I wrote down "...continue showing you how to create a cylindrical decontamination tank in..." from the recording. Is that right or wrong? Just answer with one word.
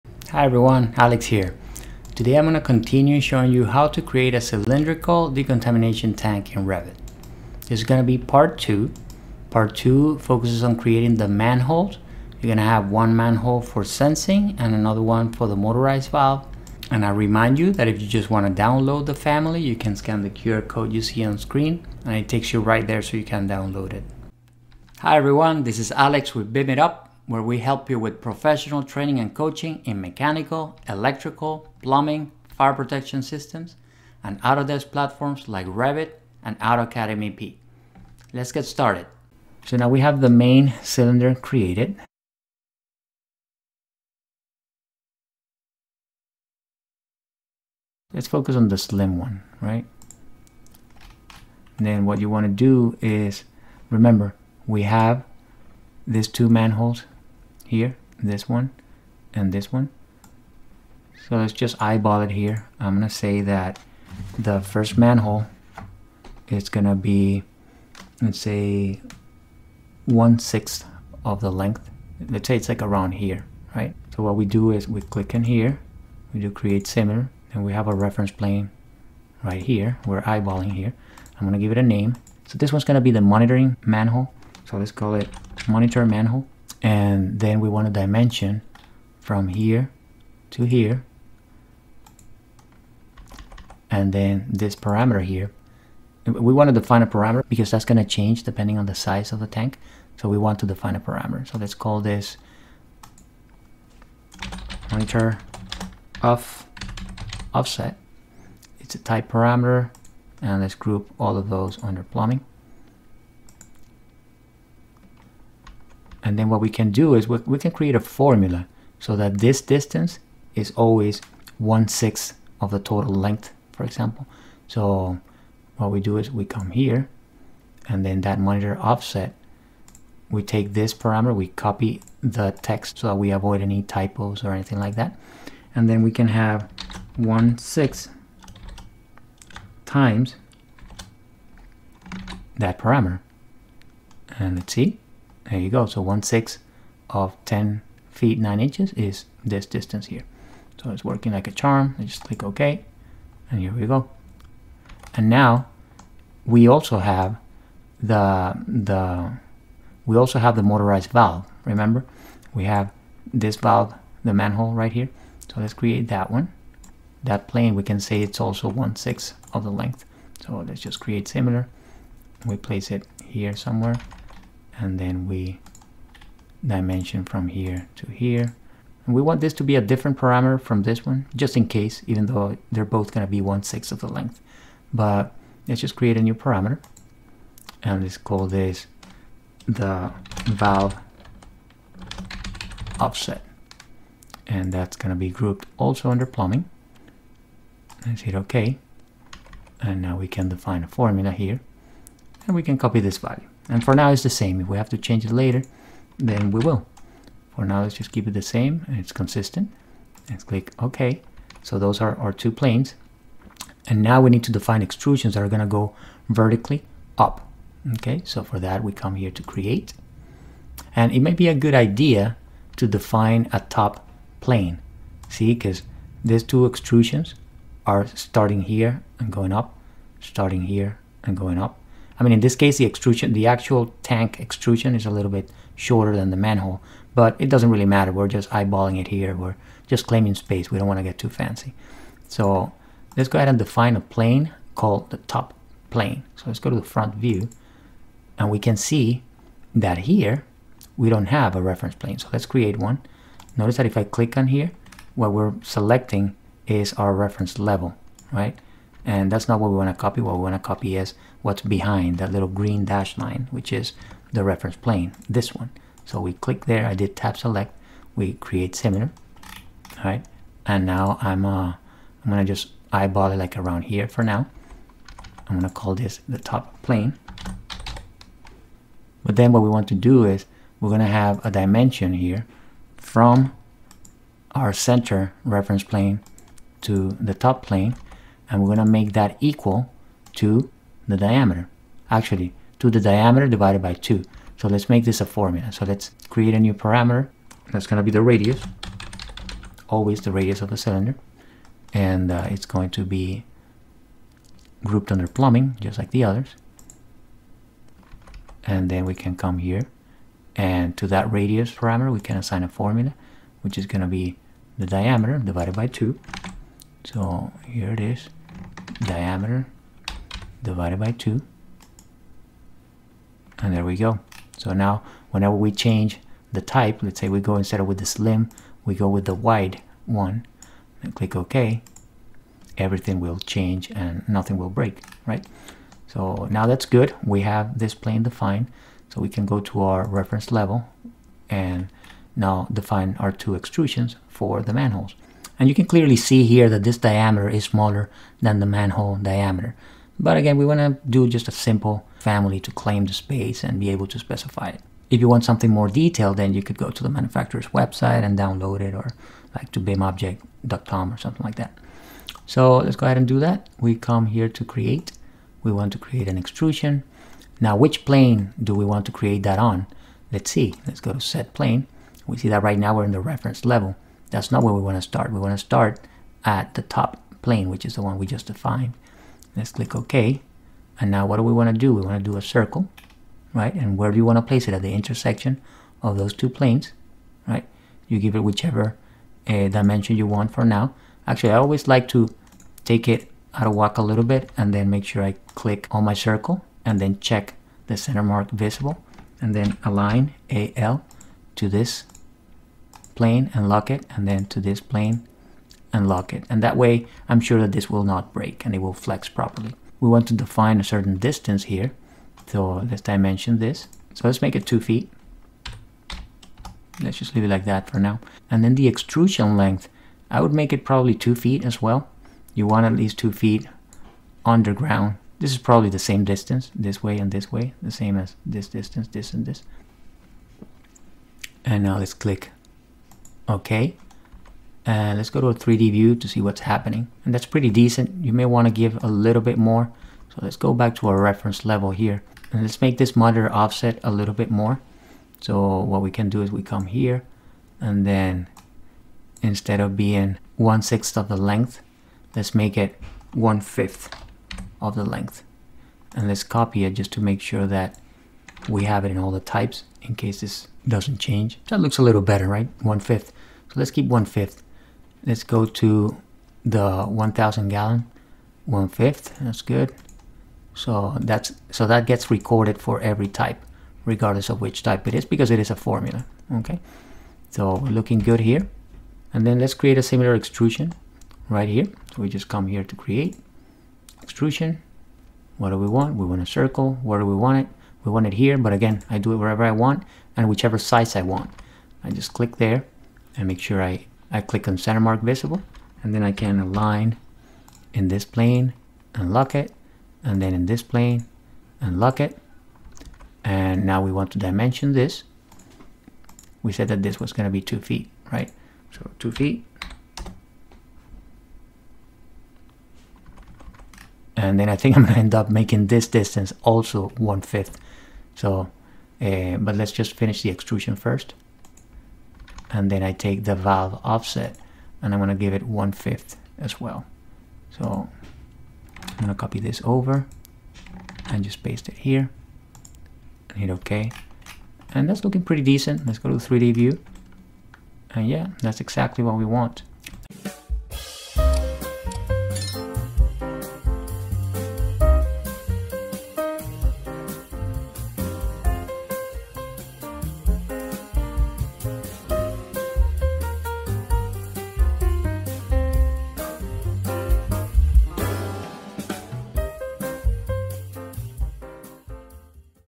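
right.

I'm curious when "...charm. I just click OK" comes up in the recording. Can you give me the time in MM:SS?
02:31.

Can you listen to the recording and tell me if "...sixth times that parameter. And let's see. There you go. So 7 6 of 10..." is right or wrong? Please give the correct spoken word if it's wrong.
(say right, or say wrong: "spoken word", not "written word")
wrong: "1", not "7".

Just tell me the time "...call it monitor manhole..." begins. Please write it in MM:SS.
01:24.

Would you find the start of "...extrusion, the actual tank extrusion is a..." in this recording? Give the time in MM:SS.
03:52.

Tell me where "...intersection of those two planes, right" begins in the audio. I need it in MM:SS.
06:24.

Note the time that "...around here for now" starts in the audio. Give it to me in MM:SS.
04:33.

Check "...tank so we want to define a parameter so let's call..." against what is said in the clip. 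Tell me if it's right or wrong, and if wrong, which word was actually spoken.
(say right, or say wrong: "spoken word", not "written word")
right.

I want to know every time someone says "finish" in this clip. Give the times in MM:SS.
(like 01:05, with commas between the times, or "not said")
08:40.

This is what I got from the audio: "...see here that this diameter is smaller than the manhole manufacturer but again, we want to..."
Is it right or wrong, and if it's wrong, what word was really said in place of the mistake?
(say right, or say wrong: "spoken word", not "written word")
wrong: "diameter", not "manufacturer".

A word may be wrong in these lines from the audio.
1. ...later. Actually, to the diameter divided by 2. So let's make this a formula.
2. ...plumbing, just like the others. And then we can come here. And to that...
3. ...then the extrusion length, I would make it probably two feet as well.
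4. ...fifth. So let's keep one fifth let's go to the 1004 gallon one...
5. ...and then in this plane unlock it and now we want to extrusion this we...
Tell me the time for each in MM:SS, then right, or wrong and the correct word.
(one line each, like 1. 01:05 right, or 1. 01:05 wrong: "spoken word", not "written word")
1. 04:51 wrong: "diameter", not "later"
2. 05:05 right
3. 06:58 right
4. 07:42 wrong: "1000", not "1004"
5. 08:20 wrong: "dimension", not "extrusion".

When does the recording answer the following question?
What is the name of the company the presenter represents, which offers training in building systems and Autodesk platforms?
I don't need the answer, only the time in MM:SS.
00:26.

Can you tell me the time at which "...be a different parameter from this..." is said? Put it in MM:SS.
02:59.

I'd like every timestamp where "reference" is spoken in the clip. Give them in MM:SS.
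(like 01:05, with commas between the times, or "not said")
01:17, 04:11, 04:17, 04:24, 04:45, 05:40, 06:13, 07:21.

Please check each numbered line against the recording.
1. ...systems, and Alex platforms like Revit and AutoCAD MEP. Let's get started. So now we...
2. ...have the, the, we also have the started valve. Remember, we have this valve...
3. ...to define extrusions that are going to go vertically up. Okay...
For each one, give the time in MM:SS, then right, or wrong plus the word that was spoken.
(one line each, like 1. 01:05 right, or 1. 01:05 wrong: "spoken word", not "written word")
1. 00:33 wrong: "Autodesk", not "Alex"
2. 02:36 wrong: "motorized", not "started"
3. 03:34 right.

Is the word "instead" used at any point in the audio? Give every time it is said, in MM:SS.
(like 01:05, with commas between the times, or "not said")
05:27, 07:29.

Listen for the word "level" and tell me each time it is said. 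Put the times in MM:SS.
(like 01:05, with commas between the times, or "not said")
04:17, 05:40, 06:13, 07:21.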